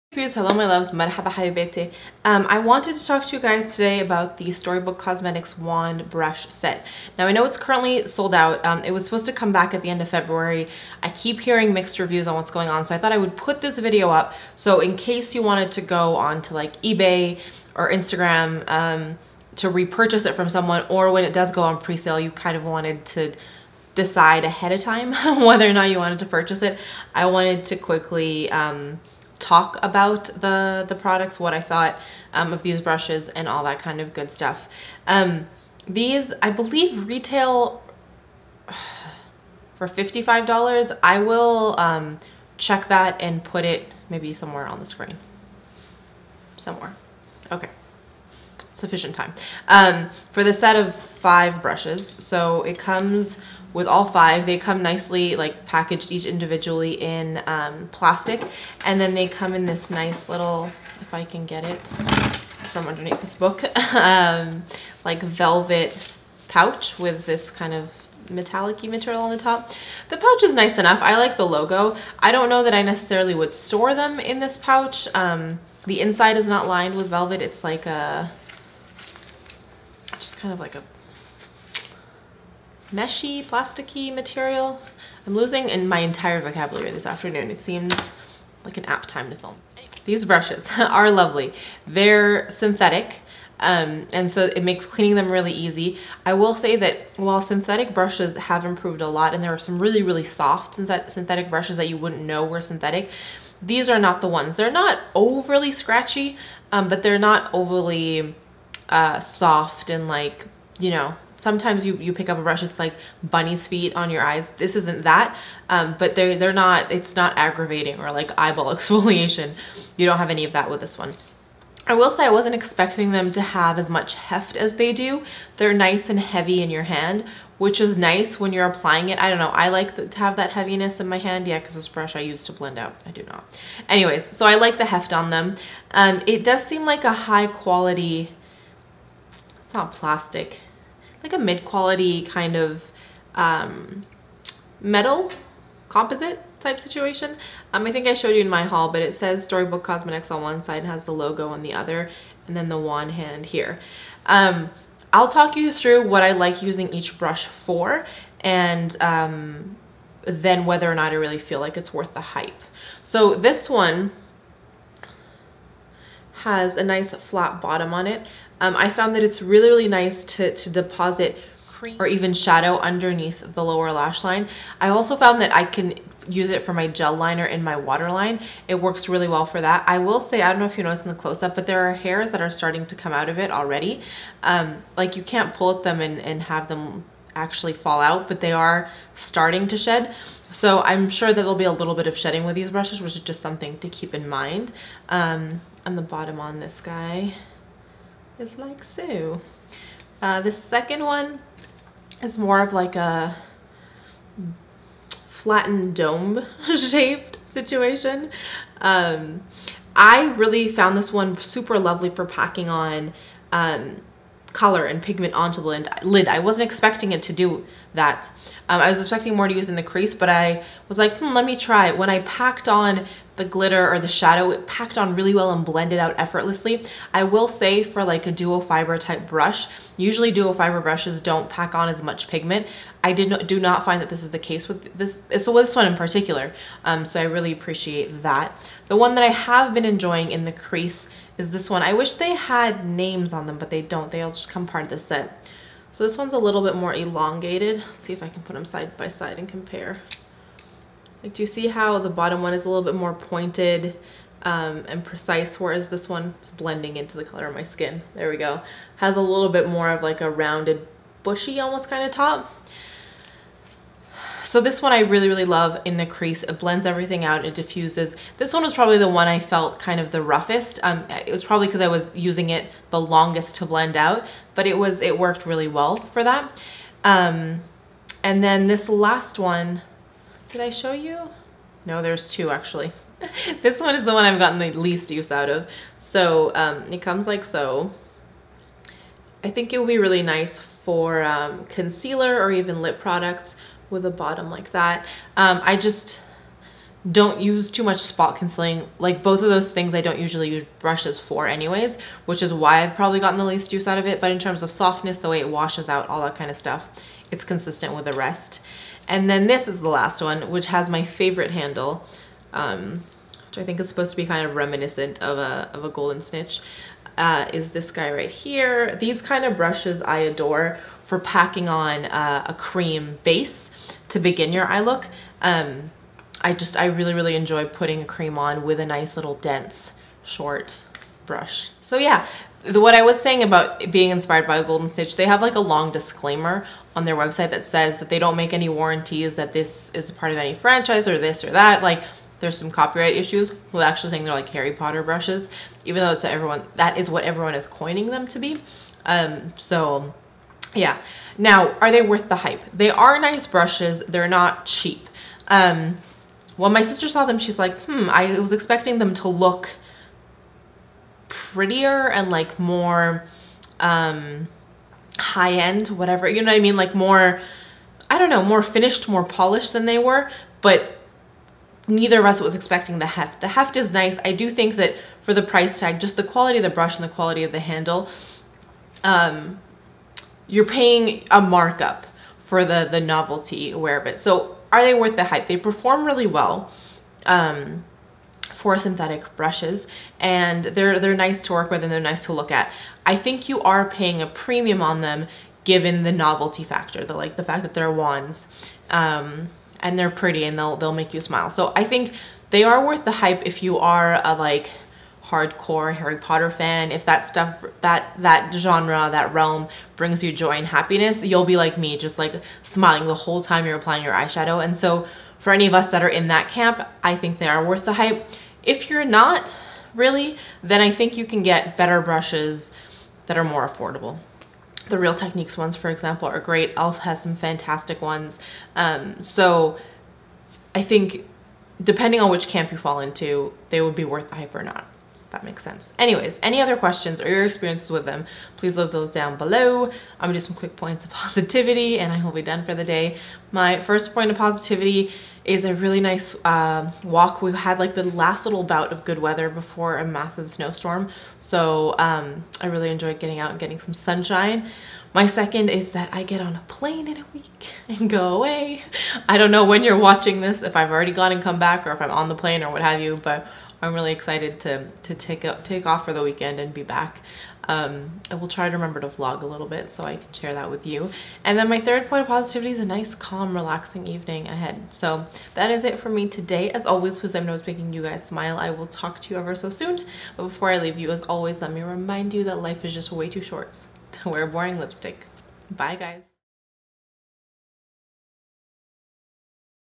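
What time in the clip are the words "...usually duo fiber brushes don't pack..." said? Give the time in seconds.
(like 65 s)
229 s.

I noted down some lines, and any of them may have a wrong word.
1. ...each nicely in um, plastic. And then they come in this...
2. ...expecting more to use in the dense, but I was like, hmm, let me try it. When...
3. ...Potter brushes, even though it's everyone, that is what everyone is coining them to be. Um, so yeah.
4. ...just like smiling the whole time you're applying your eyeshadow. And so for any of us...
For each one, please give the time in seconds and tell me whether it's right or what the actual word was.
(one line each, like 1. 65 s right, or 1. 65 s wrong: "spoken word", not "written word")
1. 56 s wrong: "individually", not "nicely"
2. 218 s wrong: "crease", not "dense"
3. 344 s right
4. 411 s right.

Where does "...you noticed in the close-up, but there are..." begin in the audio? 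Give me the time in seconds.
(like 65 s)
180 s.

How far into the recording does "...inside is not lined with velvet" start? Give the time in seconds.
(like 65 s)
76 s.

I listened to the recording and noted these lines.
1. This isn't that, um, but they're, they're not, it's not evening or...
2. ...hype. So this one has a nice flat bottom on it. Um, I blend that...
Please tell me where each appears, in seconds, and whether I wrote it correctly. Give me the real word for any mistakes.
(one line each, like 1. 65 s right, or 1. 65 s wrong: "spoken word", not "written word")
1. 114 s wrong: "aggravating", not "evening"
2. 162 s wrong: "found", not "blend".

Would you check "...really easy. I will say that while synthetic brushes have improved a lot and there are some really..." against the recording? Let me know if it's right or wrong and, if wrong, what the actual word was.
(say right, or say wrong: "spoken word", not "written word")
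right.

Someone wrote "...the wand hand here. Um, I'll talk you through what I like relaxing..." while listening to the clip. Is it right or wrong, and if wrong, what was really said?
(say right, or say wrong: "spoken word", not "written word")
wrong: "using", not "relaxing".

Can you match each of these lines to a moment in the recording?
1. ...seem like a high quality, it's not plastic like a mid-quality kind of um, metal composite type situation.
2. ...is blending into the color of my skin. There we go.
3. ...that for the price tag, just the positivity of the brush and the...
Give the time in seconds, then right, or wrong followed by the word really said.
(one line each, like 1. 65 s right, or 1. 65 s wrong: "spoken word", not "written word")
1. 136 s right
2. 256 s right
3. 374 s wrong: "quality", not "positivity".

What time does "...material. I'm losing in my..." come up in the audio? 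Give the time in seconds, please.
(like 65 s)
84 s.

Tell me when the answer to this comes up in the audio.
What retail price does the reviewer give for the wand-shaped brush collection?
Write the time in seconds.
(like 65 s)
39 s.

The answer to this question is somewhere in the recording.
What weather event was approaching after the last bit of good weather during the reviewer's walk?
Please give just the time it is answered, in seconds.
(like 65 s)
450 s.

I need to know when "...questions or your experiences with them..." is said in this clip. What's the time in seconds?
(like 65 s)
436 s.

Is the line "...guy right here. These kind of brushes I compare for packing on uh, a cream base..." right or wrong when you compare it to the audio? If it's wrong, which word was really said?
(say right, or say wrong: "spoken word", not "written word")
wrong: "adore", not "compare".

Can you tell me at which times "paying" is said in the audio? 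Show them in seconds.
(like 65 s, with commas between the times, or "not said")
380 s, 393 s.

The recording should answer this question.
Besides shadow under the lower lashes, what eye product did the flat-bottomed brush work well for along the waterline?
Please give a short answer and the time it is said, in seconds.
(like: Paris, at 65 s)
gel liner, at 176 s.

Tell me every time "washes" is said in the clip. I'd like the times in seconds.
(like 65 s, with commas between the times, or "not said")
305 s.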